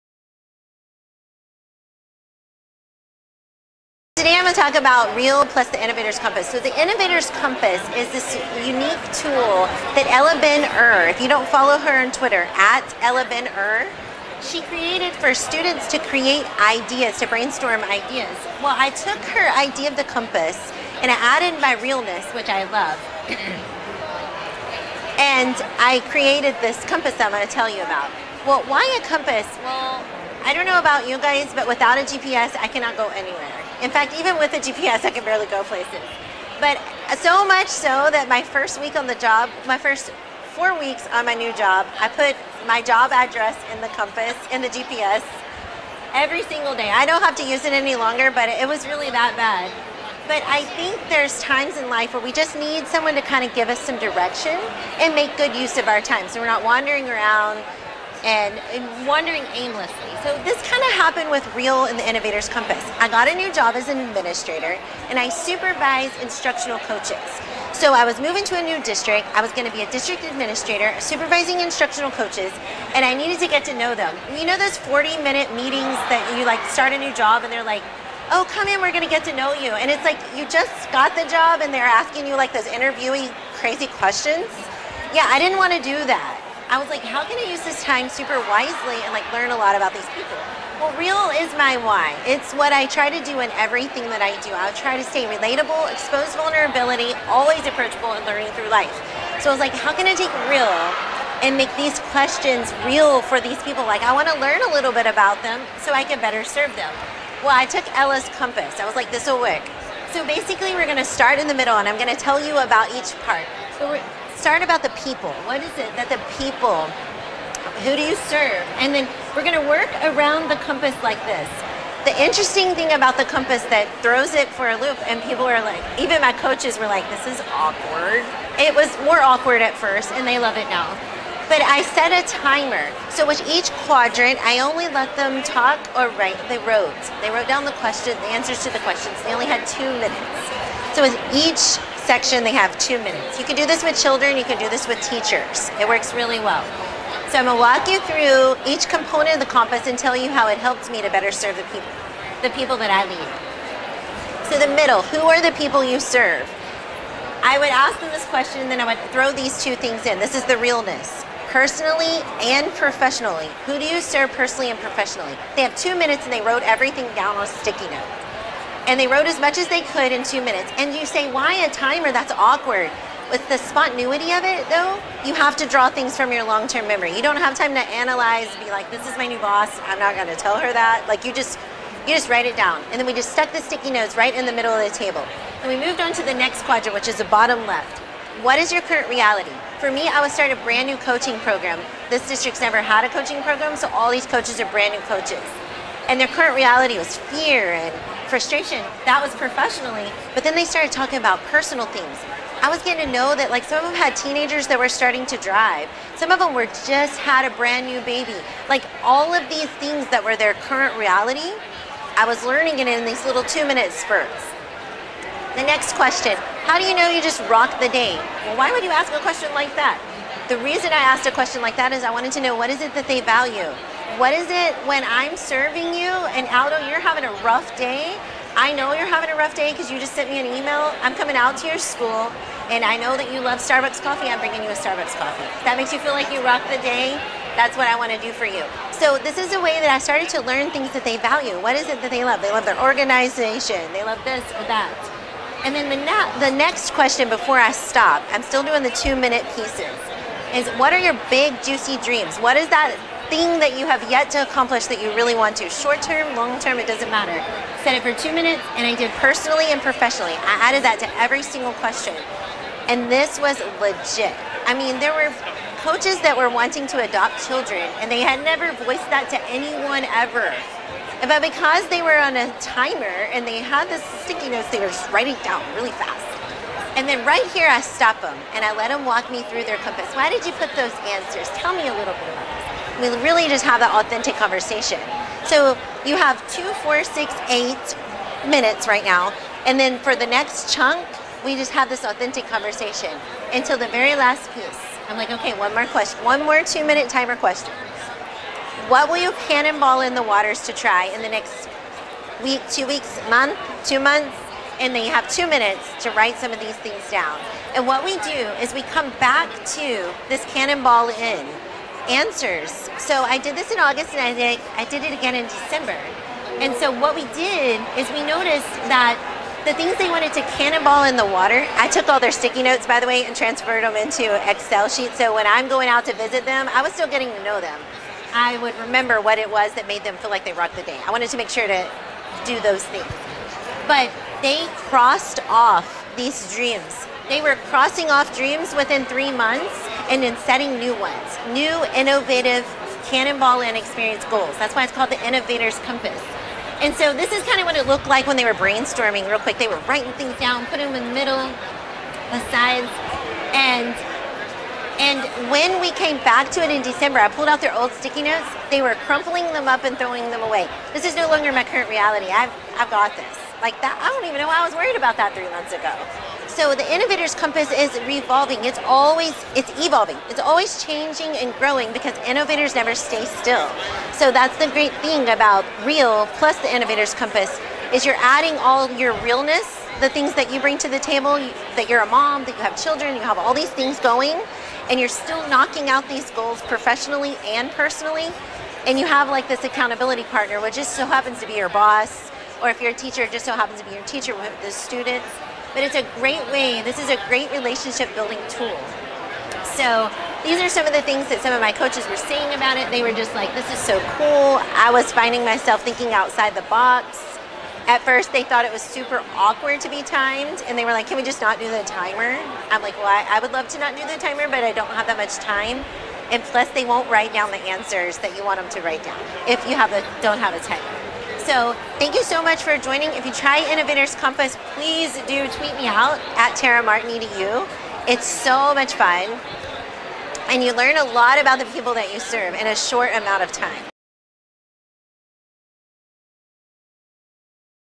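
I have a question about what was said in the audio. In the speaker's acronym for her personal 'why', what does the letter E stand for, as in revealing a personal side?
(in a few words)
Expose vulnerability.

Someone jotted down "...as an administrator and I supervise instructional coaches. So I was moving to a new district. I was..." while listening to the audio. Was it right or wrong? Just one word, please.
right.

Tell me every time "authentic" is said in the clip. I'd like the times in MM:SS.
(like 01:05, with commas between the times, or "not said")
04:43, 04:52.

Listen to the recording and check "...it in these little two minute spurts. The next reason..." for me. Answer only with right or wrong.
wrong.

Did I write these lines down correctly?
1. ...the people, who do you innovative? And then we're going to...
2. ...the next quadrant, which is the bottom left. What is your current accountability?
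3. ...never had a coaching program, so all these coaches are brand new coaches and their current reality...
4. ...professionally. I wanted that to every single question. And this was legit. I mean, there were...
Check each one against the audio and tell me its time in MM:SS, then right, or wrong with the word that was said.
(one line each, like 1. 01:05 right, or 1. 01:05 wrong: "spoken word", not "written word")
1. 01:56 wrong: "serve", not "innovative"
2. 03:06 wrong: "reality", not "accountability"
3. 03:12 right
4. 04:19 wrong: "added", not "wanted".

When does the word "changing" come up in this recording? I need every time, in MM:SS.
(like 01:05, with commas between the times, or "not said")
06:10.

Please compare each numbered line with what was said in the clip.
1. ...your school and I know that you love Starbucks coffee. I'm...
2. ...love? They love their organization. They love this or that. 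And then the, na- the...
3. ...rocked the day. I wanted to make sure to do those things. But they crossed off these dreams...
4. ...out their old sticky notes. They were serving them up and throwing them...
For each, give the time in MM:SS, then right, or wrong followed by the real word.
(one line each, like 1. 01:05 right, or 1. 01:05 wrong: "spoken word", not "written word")
1. 03:51 right
2. 04:02 right
3. 05:30 right
4. 05:57 wrong: "crumpling", not "serving".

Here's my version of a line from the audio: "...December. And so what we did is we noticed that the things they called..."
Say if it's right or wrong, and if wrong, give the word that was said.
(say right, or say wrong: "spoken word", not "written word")
wrong: "wanted", not "called".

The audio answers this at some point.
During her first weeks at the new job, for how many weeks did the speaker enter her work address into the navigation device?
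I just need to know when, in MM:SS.
00:40.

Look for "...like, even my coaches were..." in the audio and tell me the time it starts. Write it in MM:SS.
02:05.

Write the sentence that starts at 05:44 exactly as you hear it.
That's why it's called the Innovator's Compass.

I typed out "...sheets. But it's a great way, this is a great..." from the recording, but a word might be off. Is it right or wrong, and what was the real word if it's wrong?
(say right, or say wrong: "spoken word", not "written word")
wrong: "students", not "sheets".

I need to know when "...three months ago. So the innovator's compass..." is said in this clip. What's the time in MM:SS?
06:05.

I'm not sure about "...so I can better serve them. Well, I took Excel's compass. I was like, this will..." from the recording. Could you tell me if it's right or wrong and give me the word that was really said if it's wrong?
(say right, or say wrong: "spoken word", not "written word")
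wrong: "Ela", not "Excel".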